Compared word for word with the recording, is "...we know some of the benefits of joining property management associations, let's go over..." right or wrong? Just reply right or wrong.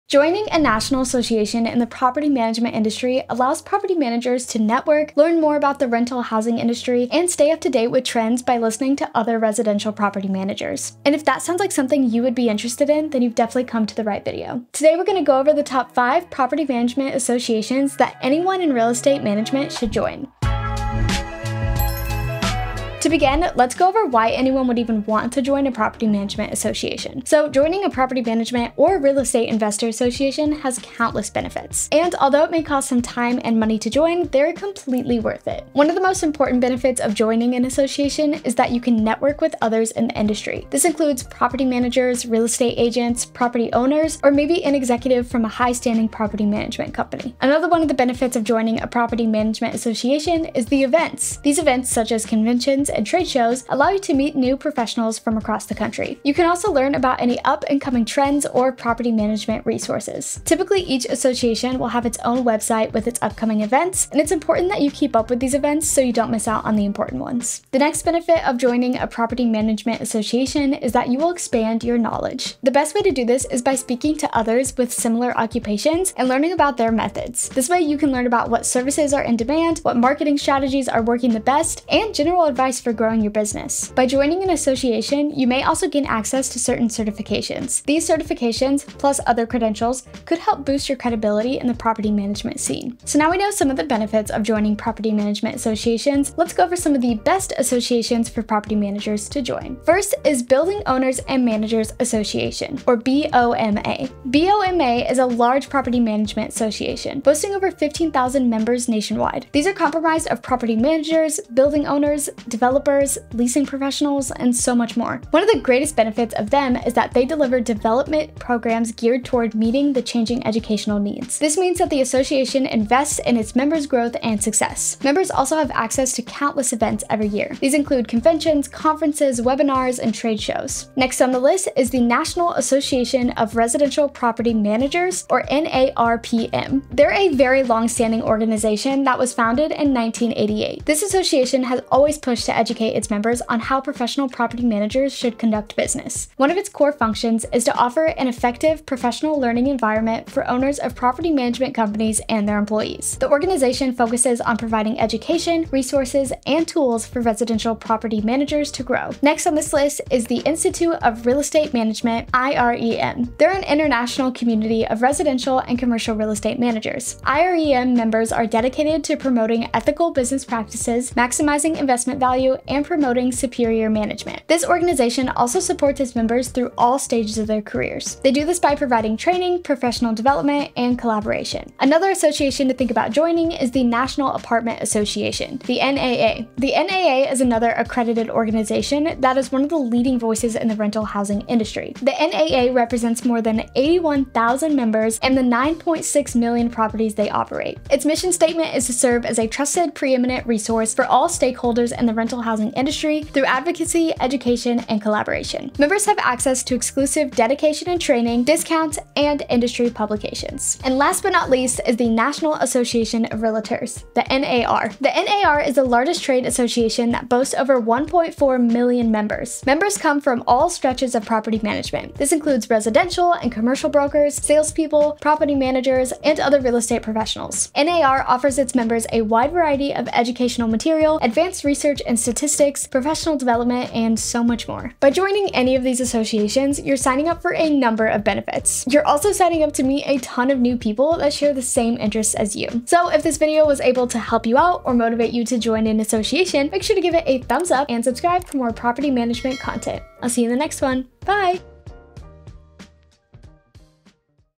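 right.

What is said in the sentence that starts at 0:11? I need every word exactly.
And if that sounds like something you would be interested in, then you've definitely come to the right video.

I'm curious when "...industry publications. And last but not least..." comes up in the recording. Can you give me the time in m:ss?
3:29.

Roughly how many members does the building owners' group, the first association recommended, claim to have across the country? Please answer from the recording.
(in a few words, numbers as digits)
15,000.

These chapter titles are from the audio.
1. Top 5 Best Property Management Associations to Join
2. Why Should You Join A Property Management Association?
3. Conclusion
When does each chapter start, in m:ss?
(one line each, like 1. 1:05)
1. 1:36
2. 0:24
3. 3:55.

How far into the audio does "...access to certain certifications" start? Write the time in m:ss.
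1:26.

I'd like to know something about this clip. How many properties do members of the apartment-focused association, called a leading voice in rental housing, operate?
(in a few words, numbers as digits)
9.6 million.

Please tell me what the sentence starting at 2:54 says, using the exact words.
This organization also supports its members through all stages of their careers.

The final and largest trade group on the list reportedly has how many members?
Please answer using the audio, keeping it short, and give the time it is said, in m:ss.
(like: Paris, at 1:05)
1.4 million, at 3:37.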